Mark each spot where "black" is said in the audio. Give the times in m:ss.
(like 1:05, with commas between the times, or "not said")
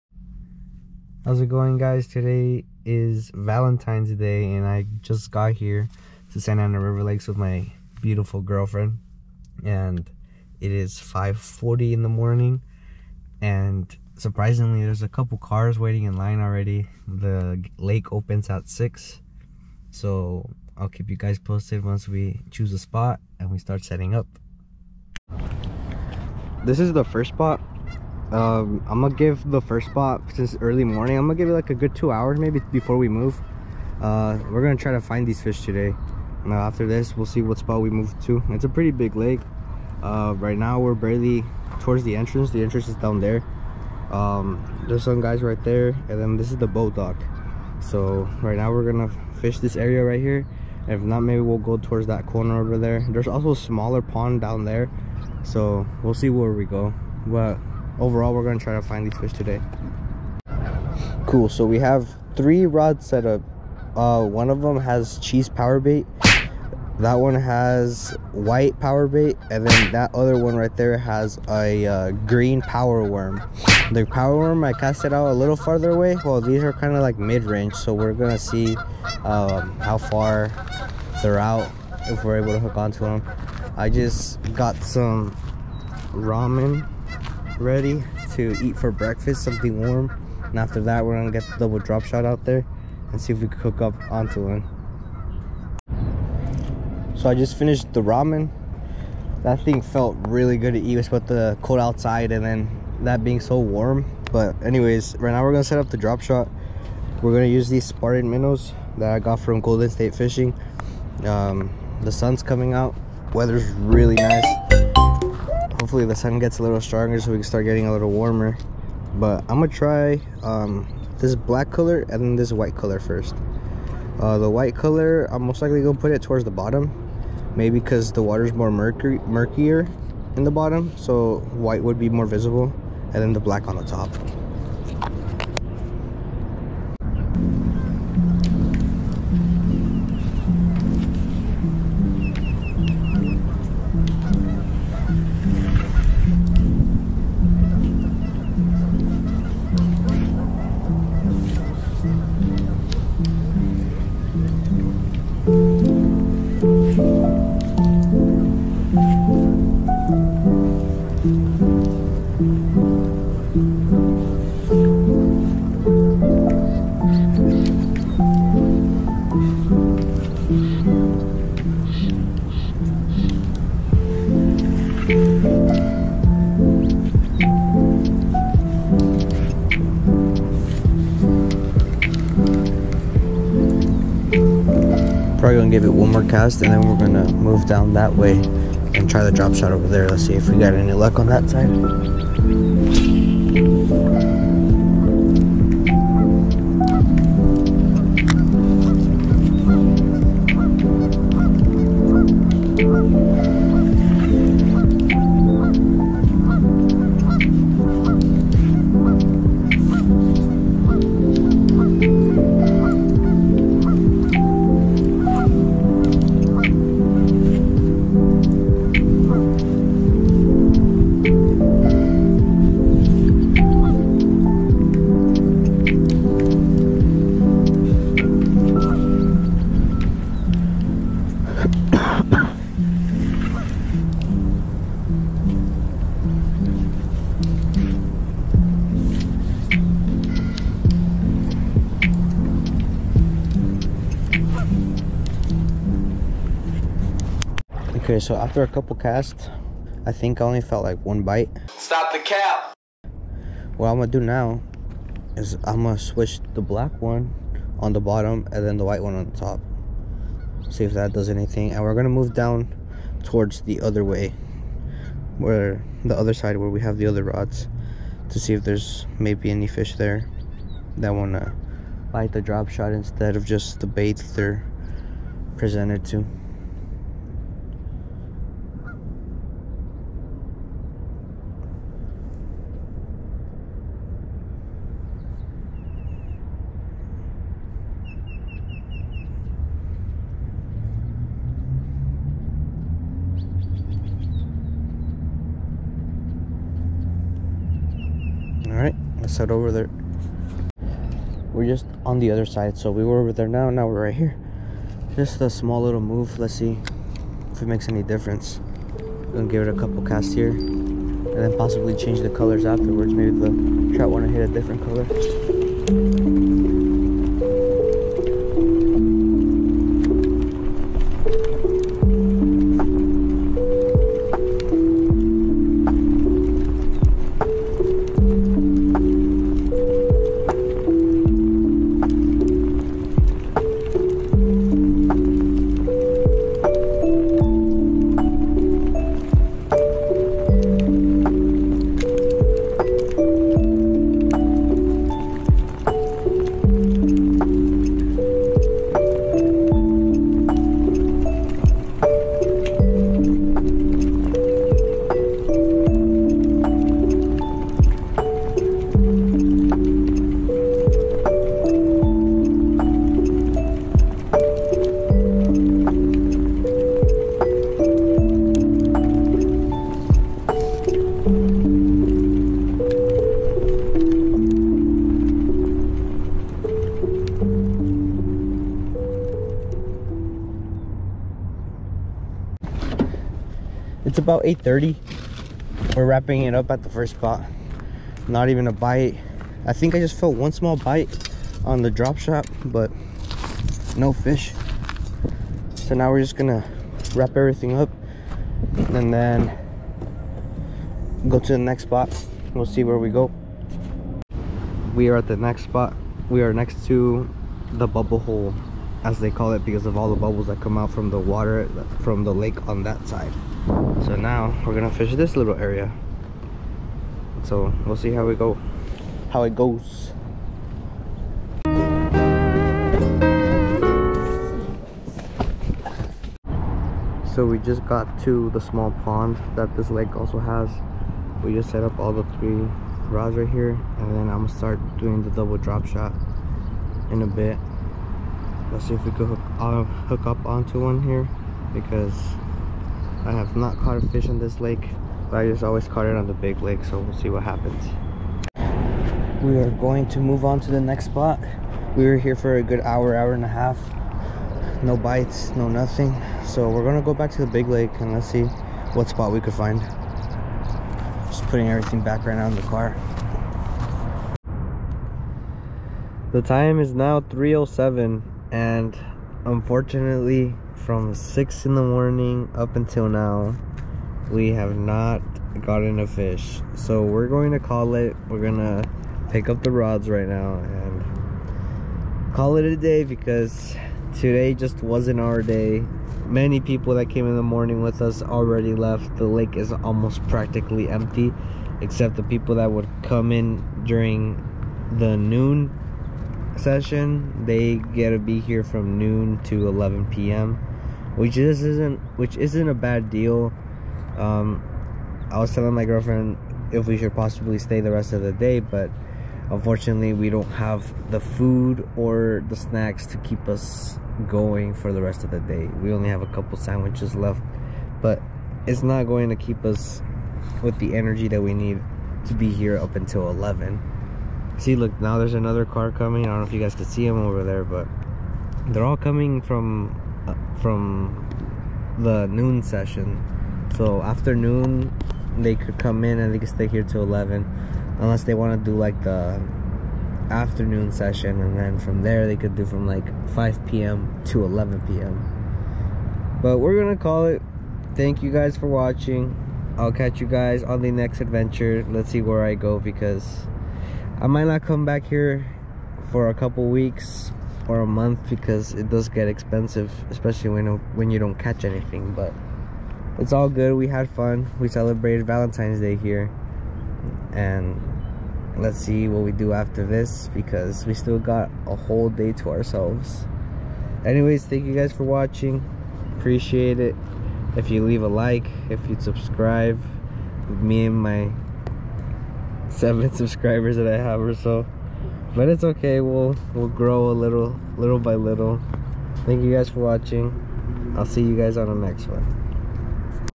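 2:01, 2:13, 4:16.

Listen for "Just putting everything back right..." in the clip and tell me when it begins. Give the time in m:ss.
7:41.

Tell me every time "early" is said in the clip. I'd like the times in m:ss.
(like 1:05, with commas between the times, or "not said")
0:30.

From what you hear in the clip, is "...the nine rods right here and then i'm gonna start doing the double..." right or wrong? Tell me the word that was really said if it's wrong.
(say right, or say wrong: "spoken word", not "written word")
wrong: "three", not "nine".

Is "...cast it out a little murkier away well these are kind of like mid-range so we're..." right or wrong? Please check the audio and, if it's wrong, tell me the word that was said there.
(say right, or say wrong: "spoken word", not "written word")
wrong: "farther", not "murkier".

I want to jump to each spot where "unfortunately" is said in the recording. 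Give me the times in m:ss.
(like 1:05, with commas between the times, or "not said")
7:49, 8:29.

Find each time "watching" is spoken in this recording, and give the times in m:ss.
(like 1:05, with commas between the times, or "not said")
9:08, 9:35, 9:49.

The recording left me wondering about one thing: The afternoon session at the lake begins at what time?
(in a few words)
5 p.m.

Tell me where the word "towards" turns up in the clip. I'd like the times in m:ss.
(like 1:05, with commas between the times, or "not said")
0:41, 0:51, 2:06, 4:23.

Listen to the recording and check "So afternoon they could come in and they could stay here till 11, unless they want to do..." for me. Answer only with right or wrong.
right.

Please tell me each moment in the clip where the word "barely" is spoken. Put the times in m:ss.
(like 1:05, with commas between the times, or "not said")
0:40.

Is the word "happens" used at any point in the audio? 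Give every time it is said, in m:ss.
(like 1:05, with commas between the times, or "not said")
7:27.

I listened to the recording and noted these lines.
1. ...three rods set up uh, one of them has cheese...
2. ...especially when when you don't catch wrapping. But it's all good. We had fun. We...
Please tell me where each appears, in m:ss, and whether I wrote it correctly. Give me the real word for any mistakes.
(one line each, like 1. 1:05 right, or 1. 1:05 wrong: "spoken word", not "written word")
1. 1:02 right
2. 9:20 wrong: "anything", not "wrapping".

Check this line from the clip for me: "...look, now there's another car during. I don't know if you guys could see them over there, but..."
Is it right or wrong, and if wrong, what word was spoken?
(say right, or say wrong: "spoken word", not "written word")
wrong: "coming", not "during".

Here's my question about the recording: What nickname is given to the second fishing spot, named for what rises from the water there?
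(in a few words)
Bubble hole.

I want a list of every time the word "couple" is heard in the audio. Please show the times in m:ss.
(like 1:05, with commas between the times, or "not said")
0:15, 4:08, 5:09, 8:36, 9:16.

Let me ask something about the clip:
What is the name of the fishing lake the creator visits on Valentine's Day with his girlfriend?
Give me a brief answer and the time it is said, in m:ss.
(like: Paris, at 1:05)
Santa Ana River Lakes, at 0:06.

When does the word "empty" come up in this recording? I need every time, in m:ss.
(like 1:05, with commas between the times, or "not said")
8:10.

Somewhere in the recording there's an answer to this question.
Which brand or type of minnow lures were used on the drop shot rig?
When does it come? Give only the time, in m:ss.
1:47.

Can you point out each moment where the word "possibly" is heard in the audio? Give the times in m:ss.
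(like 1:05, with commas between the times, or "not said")
5:11, 8:27.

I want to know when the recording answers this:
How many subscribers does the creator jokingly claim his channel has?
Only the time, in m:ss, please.
9:42.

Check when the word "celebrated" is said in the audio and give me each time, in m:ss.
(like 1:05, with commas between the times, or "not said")
9:24.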